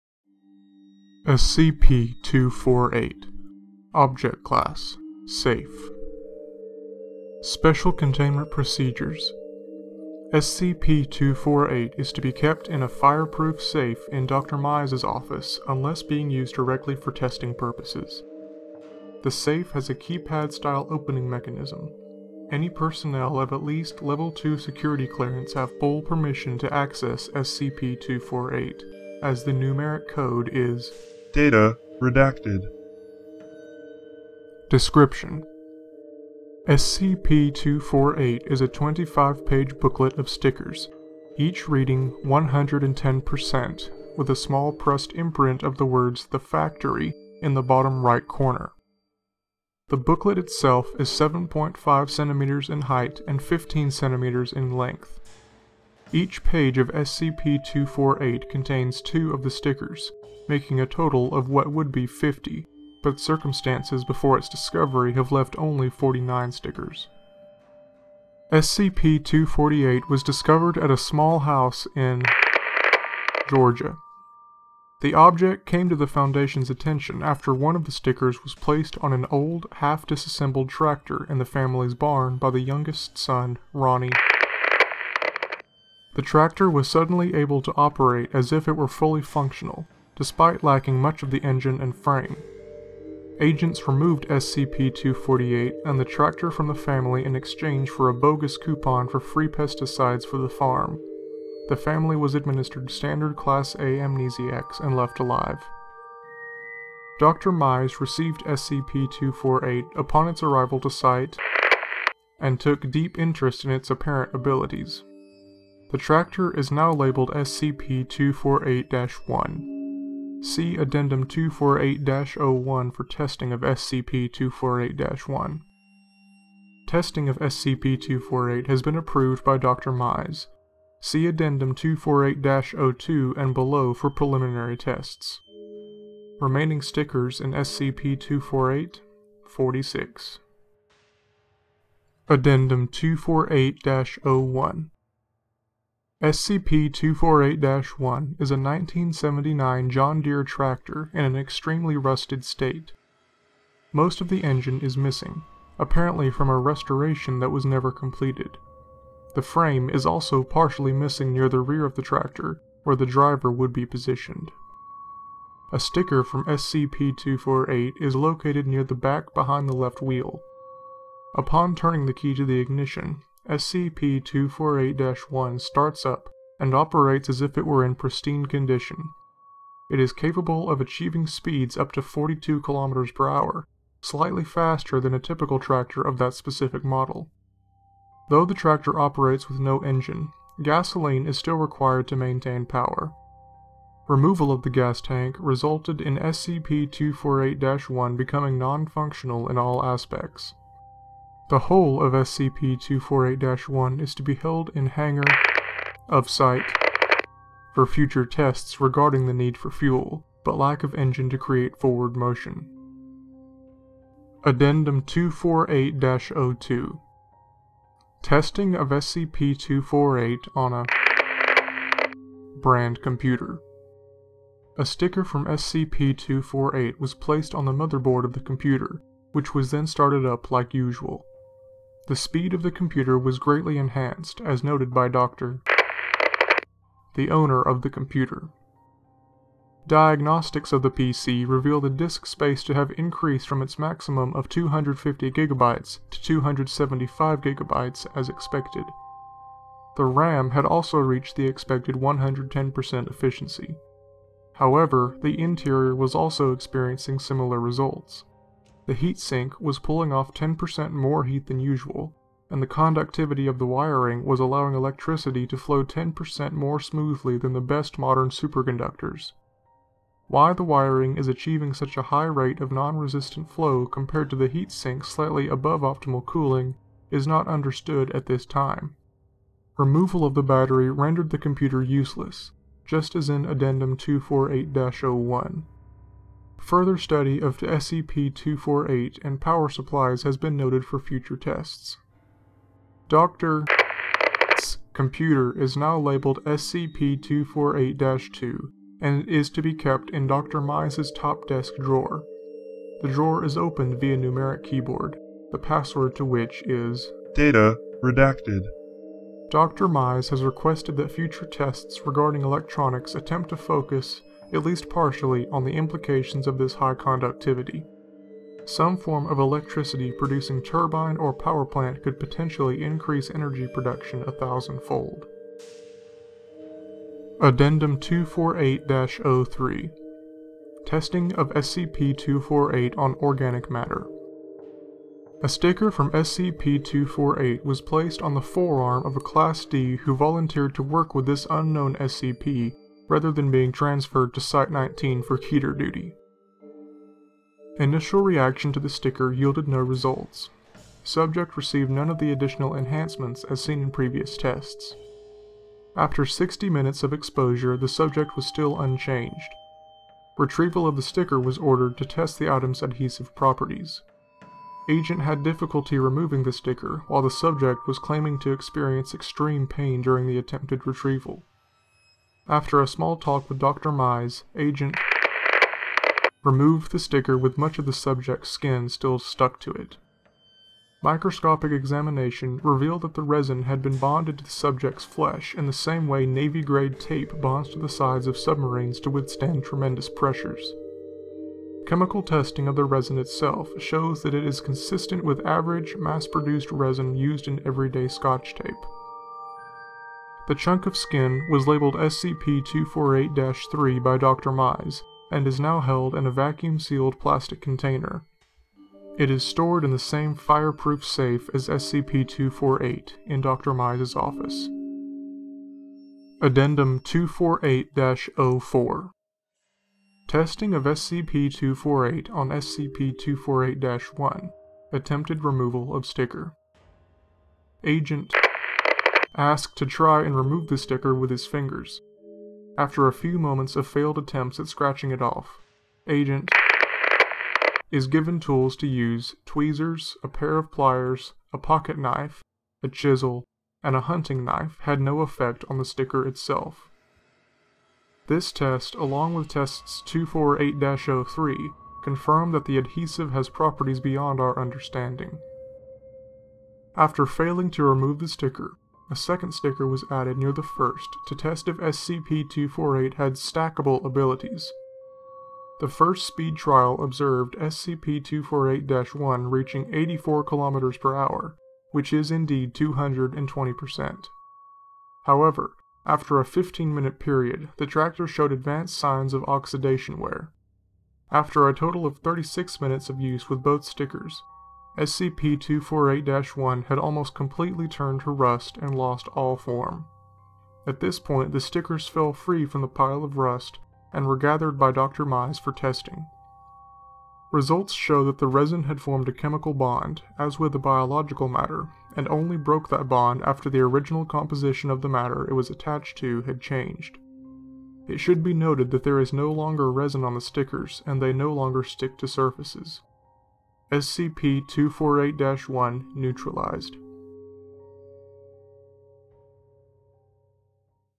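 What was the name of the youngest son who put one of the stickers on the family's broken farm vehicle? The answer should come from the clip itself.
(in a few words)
Ronnie.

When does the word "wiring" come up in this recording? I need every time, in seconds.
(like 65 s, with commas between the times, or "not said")
263 s, 270 s.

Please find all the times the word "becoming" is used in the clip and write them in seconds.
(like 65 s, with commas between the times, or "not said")
198 s.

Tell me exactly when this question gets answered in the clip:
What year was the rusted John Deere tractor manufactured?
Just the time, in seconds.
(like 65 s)
148 s.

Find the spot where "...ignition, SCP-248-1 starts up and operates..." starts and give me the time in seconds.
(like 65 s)
172 s.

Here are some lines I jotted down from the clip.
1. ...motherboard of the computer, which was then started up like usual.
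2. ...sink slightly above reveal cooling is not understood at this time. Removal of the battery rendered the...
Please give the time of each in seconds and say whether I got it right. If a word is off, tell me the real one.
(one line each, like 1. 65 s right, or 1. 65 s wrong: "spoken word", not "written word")
1. 227 s right
2. 274 s wrong: "optimal", not "reveal".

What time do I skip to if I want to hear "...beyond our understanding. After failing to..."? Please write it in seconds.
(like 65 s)
453 s.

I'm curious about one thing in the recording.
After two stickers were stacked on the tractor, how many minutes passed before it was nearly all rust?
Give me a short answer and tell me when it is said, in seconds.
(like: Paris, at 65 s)
36, at 482 s.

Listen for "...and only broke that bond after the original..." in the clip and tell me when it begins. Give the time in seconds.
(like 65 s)
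502 s.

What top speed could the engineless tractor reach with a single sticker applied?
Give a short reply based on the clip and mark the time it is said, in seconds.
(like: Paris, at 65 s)
42 km per hour, at 182 s.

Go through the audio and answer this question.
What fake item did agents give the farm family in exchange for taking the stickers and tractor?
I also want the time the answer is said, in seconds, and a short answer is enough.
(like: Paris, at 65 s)
coupon for free pesticides, at 98 s.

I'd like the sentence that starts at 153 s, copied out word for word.
Most of the engine is missing, apparently from a restoration that was never completed.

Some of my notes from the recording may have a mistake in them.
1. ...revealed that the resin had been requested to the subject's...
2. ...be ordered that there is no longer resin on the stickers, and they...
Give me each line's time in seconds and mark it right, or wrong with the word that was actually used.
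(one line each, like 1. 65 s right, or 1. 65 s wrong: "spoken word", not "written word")
1. 382 s wrong: "bonded", not "requested"
2. 508 s wrong: "noted", not "ordered".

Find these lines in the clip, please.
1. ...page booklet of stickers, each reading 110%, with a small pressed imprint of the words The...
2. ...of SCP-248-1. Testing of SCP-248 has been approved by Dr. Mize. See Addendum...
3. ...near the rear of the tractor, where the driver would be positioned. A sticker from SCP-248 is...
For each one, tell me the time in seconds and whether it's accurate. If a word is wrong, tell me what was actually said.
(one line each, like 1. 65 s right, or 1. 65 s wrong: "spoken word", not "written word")
1. 39 s right
2. 123 s right
3. 161 s right.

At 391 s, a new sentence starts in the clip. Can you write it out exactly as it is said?
Chemical testing of the resin itself shows that it is consistent with average mass produced resin used in everyday scotch tape.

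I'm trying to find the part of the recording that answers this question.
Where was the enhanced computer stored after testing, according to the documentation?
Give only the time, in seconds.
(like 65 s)
300 s.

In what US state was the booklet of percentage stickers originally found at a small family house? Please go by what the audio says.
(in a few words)
Georgia.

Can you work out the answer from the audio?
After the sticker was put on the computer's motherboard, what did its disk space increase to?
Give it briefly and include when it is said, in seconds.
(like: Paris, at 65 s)
275 GB, at 246 s.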